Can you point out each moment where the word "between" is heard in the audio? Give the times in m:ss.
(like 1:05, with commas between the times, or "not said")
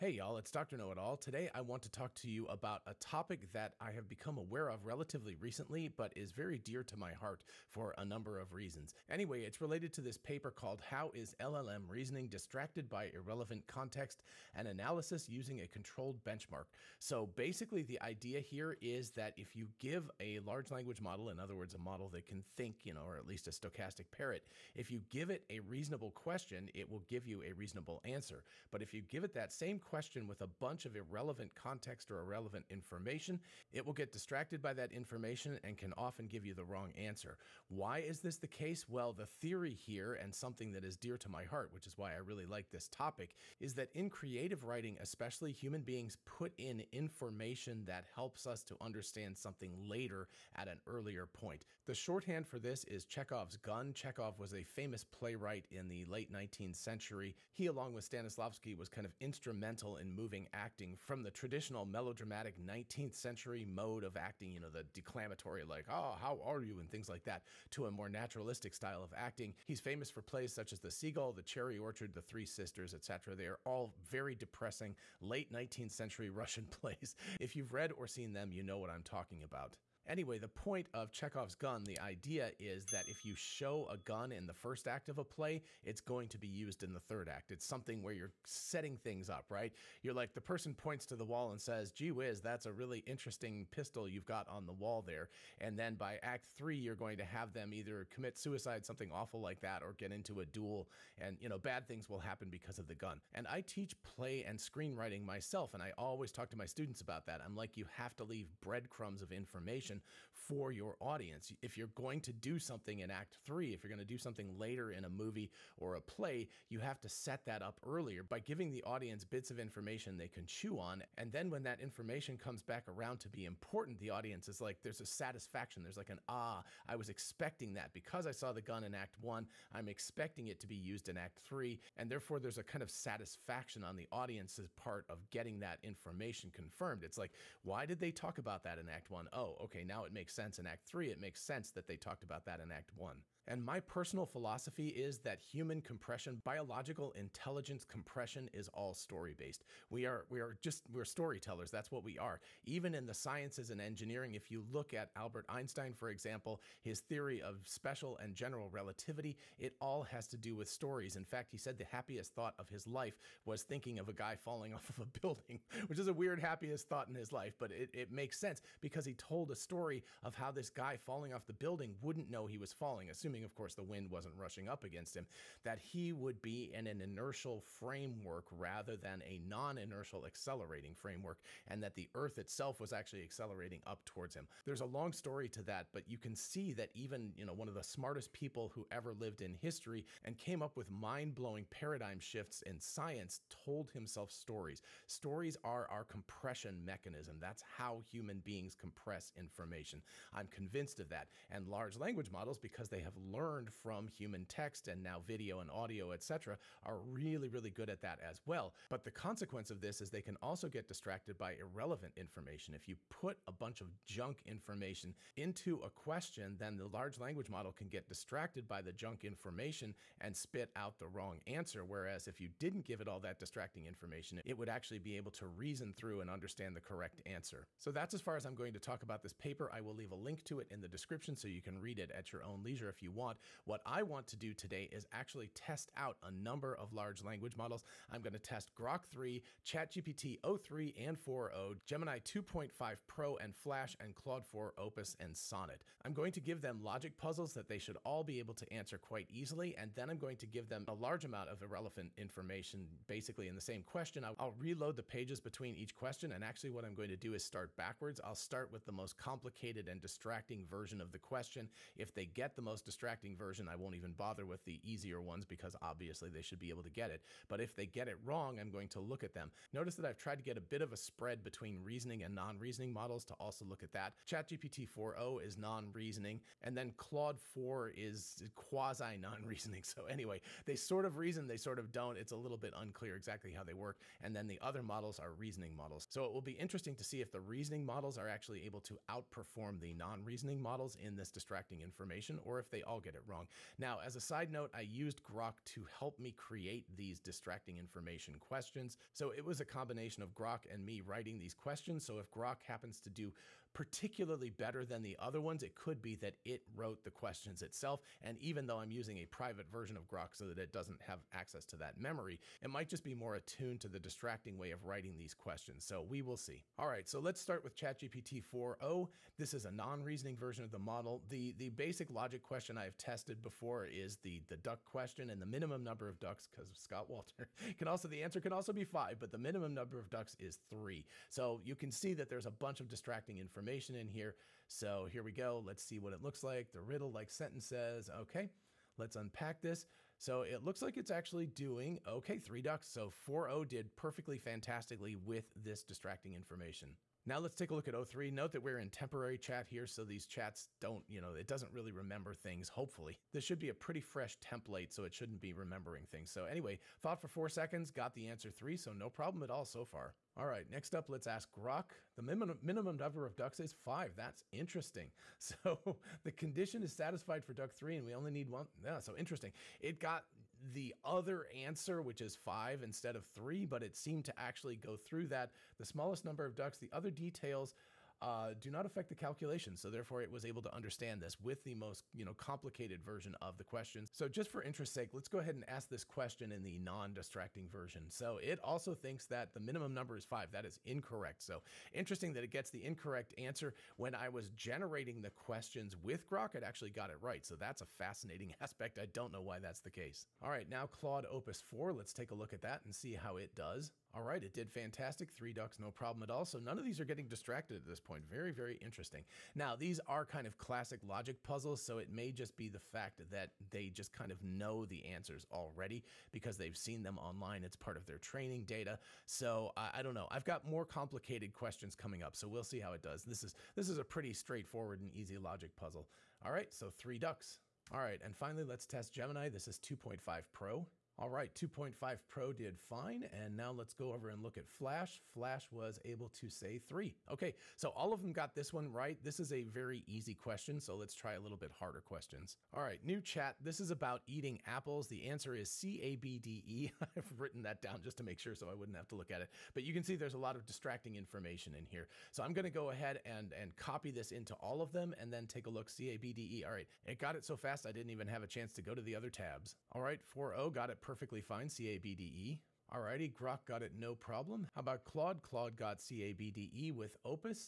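4:15, 4:31.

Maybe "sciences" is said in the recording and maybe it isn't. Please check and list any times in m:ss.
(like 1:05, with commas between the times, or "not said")
2:33, 3:12.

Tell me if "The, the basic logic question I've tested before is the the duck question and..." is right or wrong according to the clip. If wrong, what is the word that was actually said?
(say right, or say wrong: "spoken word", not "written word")
right.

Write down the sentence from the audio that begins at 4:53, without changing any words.
Now, as a side note, I used Grok to help me create these distracting information questions.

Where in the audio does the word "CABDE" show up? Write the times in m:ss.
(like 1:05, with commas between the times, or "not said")
7:41, 7:45.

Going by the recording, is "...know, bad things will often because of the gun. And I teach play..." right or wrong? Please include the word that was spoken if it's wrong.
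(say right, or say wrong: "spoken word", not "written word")
wrong: "happen", not "often".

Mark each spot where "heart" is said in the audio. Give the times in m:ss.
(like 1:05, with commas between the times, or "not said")
0:07, 0:41.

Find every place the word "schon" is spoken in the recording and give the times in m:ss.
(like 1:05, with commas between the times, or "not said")
not said.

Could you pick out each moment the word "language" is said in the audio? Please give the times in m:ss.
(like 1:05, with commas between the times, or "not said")
0:20, 3:21, 3:37, 3:57.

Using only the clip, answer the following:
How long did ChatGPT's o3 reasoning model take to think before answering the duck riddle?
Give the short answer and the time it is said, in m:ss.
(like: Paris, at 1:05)
4 seconds, at 5:57.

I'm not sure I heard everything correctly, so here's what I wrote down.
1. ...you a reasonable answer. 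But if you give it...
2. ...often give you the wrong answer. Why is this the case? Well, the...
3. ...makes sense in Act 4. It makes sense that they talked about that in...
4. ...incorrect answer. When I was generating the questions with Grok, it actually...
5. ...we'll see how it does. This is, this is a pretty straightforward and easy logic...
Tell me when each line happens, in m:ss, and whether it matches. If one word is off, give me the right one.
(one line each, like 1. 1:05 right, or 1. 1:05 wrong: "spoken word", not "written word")
1. 0:27 right
2. 0:35 right
3. 2:20 wrong: "3", not "4"
4. 6:32 right
5. 7:02 right.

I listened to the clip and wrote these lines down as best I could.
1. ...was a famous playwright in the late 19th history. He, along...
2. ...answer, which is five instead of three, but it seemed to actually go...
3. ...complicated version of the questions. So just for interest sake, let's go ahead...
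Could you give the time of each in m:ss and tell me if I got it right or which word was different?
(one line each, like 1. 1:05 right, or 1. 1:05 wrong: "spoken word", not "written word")
1. 0:54 wrong: "century", not "history"
2. 6:11 right
3. 6:22 right.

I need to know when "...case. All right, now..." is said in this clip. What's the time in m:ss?
6:39.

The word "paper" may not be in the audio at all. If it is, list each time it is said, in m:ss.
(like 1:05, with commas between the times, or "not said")
0:10, 3:49.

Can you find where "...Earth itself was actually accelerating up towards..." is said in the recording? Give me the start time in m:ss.
3:02.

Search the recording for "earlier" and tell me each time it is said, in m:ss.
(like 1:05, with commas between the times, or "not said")
0:50, 1:57.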